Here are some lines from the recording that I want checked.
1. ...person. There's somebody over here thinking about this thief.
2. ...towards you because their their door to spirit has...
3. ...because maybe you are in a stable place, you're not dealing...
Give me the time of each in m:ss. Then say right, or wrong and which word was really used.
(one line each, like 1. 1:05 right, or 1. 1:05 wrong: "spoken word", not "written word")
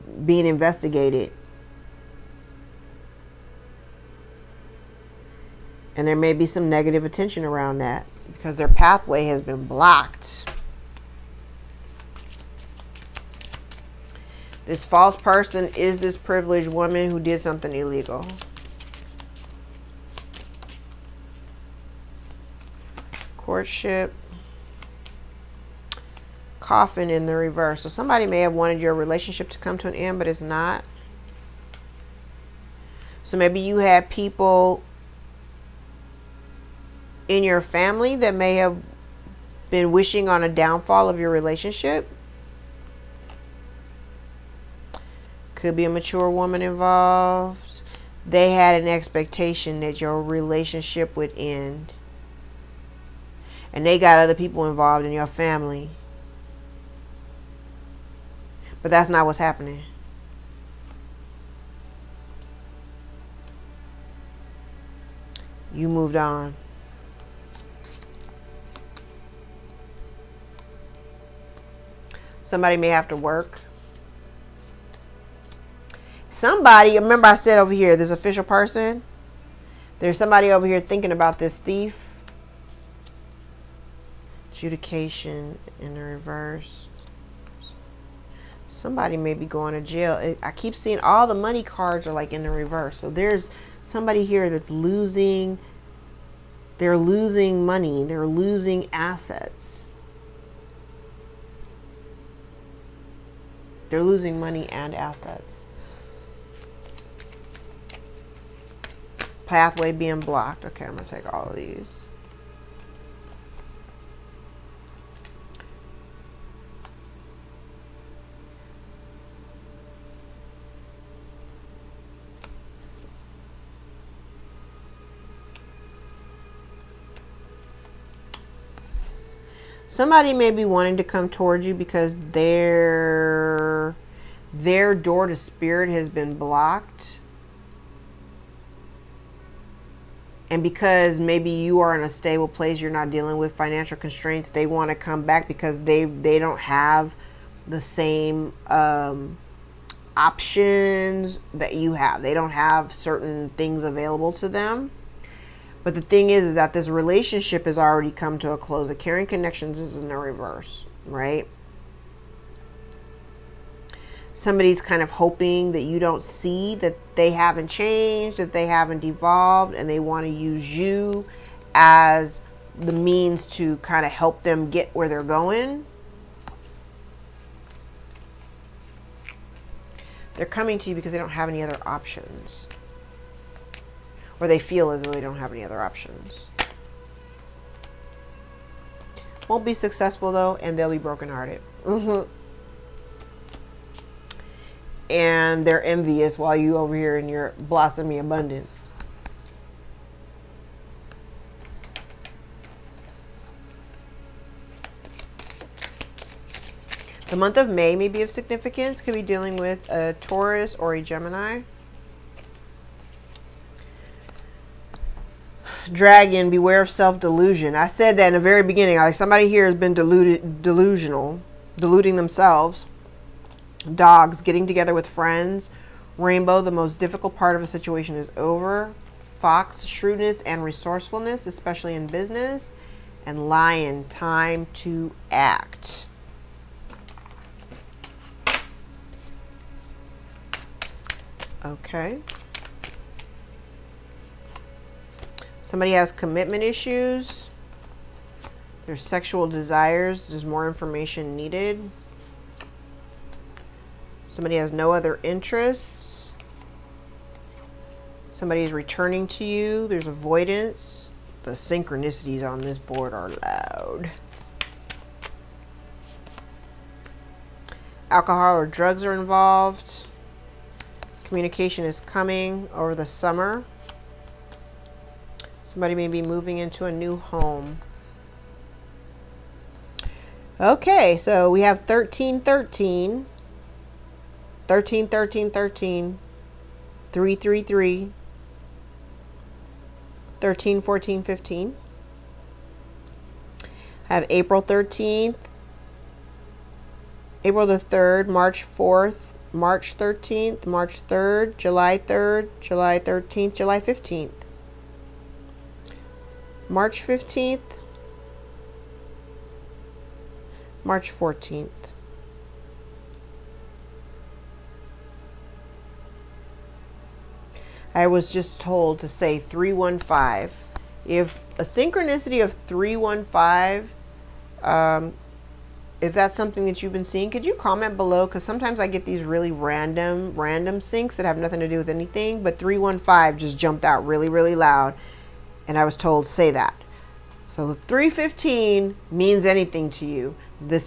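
1. 1:18 right
2. 2:11 right
3. 2:20 right.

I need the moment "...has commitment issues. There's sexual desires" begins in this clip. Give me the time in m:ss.
4:05.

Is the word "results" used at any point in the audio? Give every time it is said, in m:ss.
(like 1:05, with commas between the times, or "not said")
not said.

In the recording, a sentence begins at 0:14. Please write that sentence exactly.
This false person is this privileged woman who did something illegal.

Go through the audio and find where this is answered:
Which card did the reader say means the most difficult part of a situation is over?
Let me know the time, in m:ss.
3:46.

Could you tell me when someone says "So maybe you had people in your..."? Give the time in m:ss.
0:33.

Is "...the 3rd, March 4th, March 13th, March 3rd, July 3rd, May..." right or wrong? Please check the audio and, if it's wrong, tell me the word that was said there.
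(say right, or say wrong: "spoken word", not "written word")
wrong: "July", not "May".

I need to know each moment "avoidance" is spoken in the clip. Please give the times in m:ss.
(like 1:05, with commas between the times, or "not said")
4:20.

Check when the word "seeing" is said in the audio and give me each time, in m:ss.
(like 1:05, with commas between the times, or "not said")
1:30, 5:27.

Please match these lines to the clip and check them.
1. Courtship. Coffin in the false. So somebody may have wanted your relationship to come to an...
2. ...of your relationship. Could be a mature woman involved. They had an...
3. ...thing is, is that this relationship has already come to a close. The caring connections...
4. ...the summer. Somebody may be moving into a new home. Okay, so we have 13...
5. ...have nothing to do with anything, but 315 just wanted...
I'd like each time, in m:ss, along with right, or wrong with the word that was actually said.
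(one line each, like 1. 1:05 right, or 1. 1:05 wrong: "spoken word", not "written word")
1. 0:23 wrong: "reverse", not "false"
2. 0:41 right
3. 2:36 right
4. 4:32 right
5. 5:31 wrong: "jumped", not "wanted".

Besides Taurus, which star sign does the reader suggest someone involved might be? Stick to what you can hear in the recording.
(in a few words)
Gemini.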